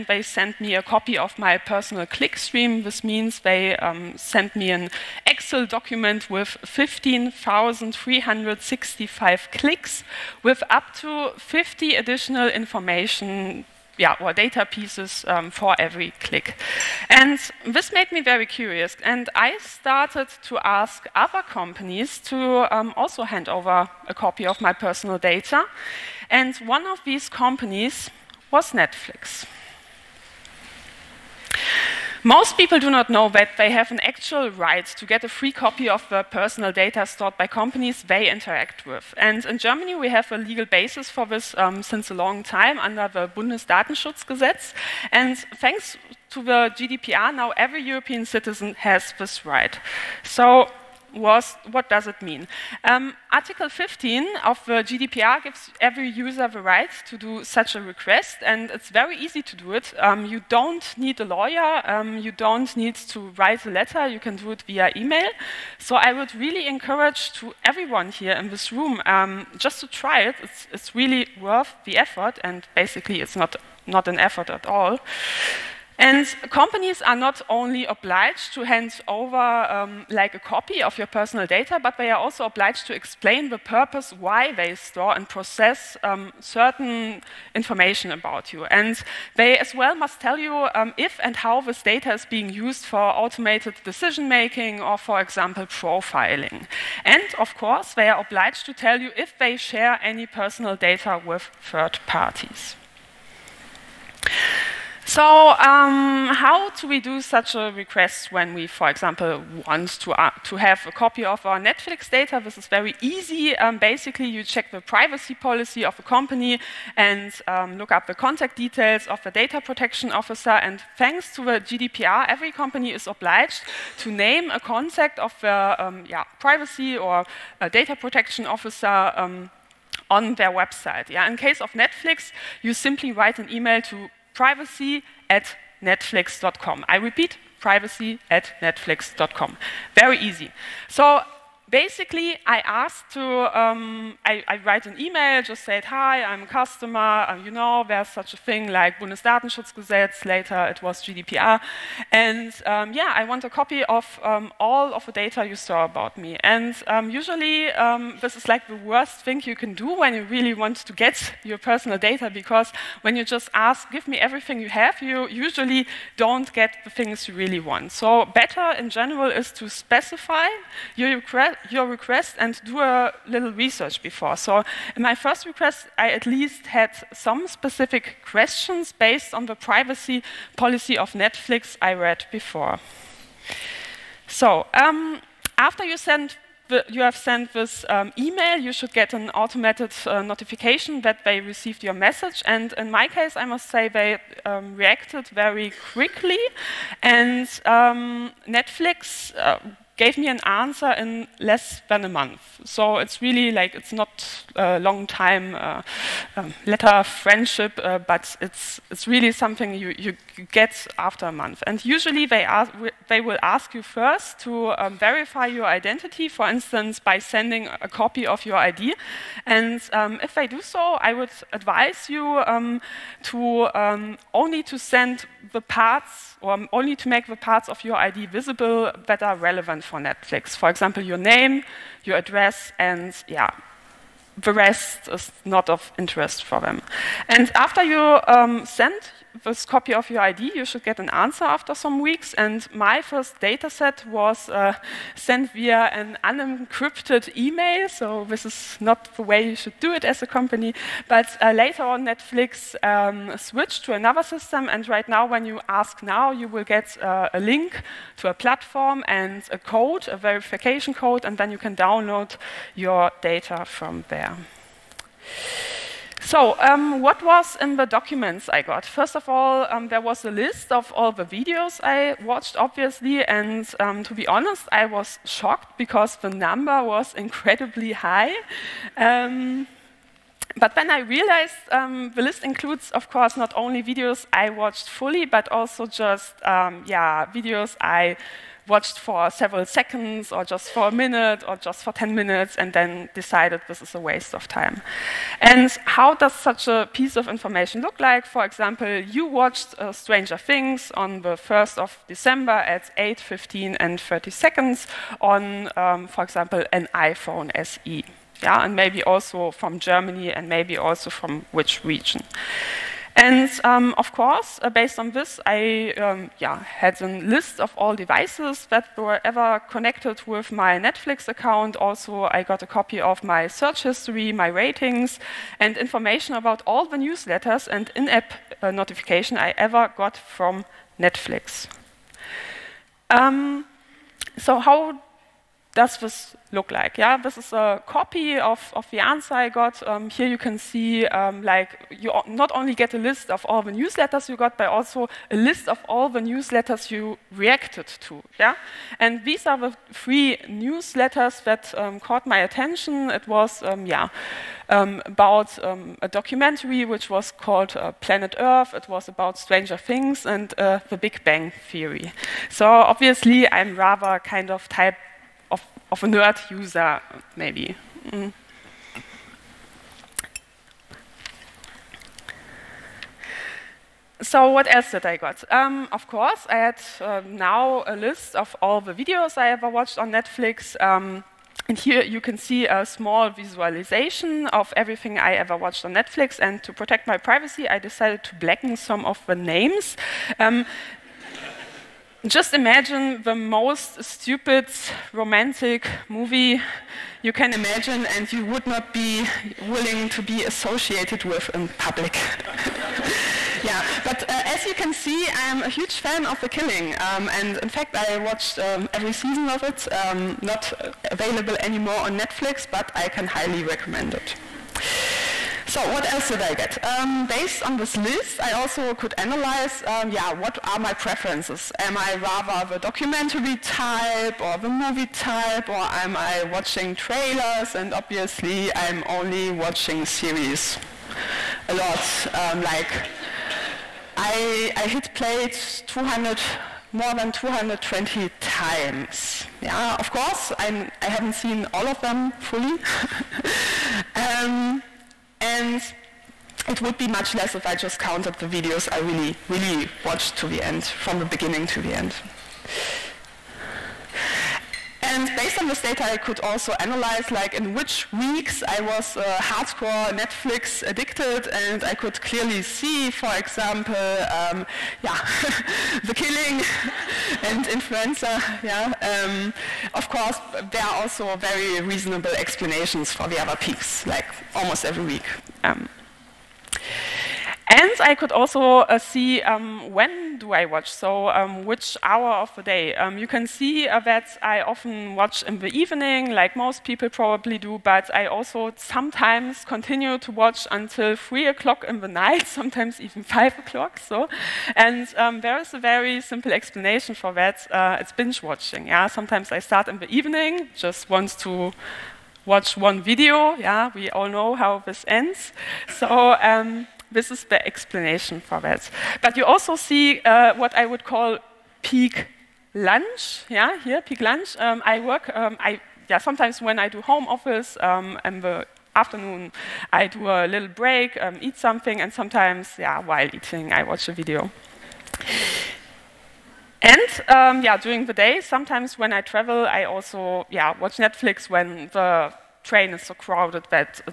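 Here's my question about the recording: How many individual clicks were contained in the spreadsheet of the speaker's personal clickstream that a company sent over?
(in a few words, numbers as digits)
15,365.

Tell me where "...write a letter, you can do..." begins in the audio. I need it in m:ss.
1:03.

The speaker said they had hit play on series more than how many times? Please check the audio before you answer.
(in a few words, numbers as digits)
220.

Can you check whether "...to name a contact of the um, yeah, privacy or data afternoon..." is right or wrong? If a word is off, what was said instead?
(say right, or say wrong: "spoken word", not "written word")
wrong: "protection", not "afternoon".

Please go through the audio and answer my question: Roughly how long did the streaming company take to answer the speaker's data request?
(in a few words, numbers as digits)
less than a month.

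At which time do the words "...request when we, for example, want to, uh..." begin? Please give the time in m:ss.
1:47.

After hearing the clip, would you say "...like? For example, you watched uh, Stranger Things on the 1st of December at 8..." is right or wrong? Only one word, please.
right.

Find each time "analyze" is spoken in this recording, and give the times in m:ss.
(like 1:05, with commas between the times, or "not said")
6:59, 7:36.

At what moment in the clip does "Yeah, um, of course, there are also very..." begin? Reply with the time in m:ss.
7:48.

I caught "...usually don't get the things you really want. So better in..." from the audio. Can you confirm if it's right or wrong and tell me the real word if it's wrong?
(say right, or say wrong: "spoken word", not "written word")
right.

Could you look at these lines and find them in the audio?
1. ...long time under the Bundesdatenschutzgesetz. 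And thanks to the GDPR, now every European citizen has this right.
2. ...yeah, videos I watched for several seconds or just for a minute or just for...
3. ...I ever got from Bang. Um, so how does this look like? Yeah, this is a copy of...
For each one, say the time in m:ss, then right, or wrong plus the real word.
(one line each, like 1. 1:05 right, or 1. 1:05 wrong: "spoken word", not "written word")
1. 0:42 right
2. 4:46 right
3. 5:29 wrong: "Netflix", not "Bang".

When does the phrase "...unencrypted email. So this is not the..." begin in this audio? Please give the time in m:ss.
4:06.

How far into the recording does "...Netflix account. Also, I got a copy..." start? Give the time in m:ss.
5:20.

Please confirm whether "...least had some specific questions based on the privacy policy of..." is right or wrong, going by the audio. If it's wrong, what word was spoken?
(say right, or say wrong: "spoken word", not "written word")
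right.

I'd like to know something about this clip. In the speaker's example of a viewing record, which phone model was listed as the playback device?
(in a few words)
iPhone SE.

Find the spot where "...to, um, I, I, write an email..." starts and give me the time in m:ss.
2:23.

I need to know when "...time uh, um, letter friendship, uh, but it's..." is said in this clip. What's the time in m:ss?
3:25.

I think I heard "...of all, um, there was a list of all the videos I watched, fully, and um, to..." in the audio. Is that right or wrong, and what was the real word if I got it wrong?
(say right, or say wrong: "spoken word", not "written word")
wrong: "obviously", not "fully".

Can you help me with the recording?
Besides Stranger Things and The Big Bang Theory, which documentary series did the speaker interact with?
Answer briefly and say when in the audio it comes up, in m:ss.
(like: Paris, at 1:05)
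Planet Earth, at 5:57.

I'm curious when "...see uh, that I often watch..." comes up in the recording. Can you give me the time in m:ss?
8:03.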